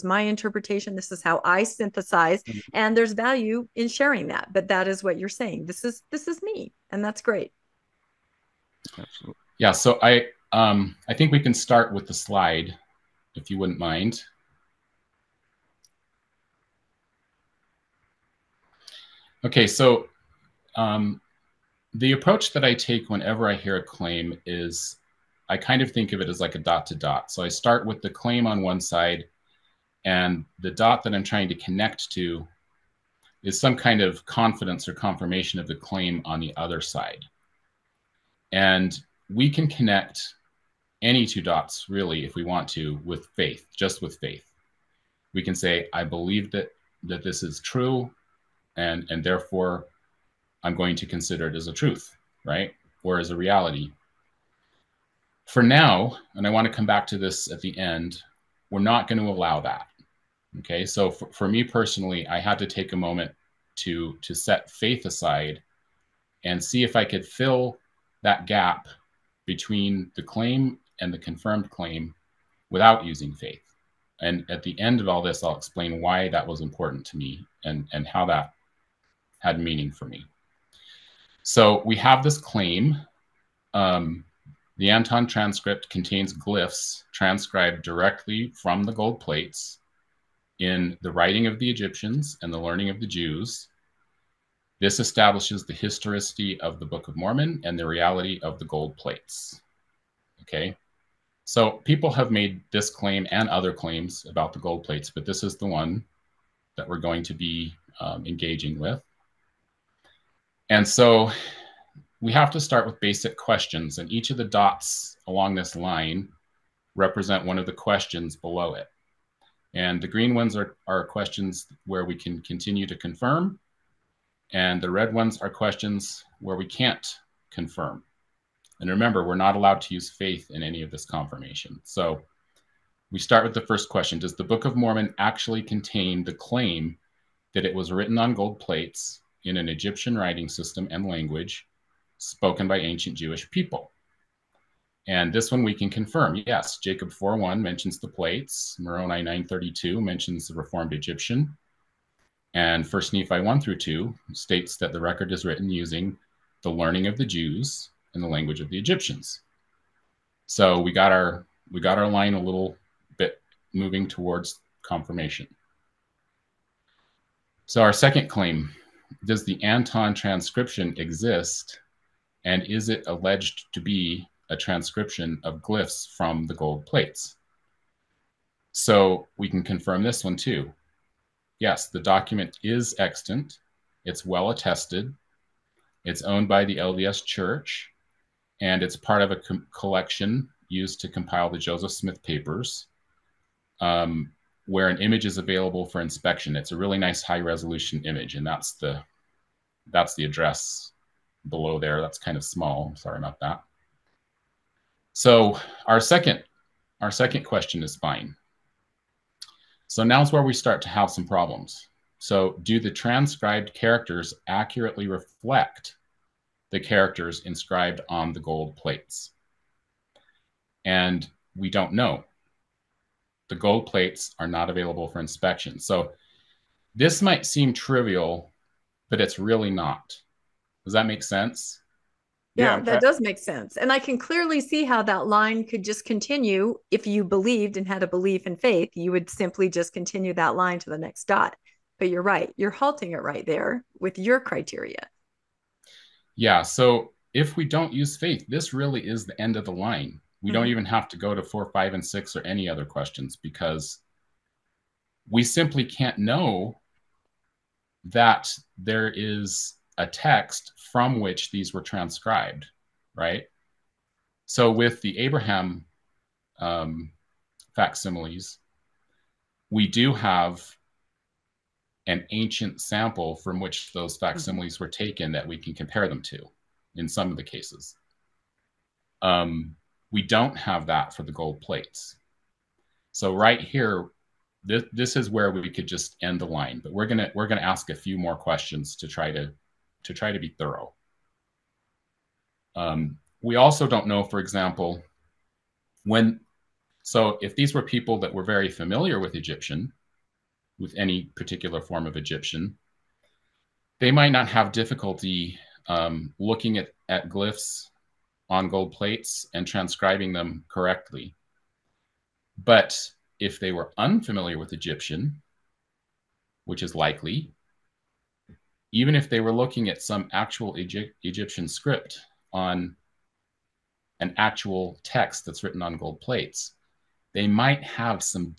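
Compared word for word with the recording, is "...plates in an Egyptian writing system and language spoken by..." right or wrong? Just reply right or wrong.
right.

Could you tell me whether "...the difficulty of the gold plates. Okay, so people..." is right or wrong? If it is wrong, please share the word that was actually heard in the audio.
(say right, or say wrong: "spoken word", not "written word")
wrong: "reality", not "difficulty".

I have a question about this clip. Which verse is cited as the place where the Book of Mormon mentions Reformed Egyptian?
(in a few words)
Moroni 9:32.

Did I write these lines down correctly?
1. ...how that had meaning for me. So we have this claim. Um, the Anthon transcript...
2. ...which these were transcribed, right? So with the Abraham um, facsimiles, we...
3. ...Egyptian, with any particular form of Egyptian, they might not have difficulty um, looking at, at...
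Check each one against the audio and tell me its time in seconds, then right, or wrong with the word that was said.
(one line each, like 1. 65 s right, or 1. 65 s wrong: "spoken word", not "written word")
1. 78 s right
2. 261 s right
3. 299 s right.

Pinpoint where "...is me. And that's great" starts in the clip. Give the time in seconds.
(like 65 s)
6 s.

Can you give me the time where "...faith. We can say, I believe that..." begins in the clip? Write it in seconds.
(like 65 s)
44 s.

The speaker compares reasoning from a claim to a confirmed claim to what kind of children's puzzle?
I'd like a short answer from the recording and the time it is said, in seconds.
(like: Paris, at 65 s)
Dot to dot, at 26 s.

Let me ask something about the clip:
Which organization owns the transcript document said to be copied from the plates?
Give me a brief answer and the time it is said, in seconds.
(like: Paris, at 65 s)
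The LDS Church, at 186 s.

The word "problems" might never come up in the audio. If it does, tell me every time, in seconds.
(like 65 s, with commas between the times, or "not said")
211 s.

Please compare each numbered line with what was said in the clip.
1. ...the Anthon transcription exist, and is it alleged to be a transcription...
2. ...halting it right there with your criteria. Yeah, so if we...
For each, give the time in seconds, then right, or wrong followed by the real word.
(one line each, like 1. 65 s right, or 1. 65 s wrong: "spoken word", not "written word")
1. 169 s right
2. 242 s right.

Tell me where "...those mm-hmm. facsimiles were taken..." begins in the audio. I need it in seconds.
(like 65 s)
273 s.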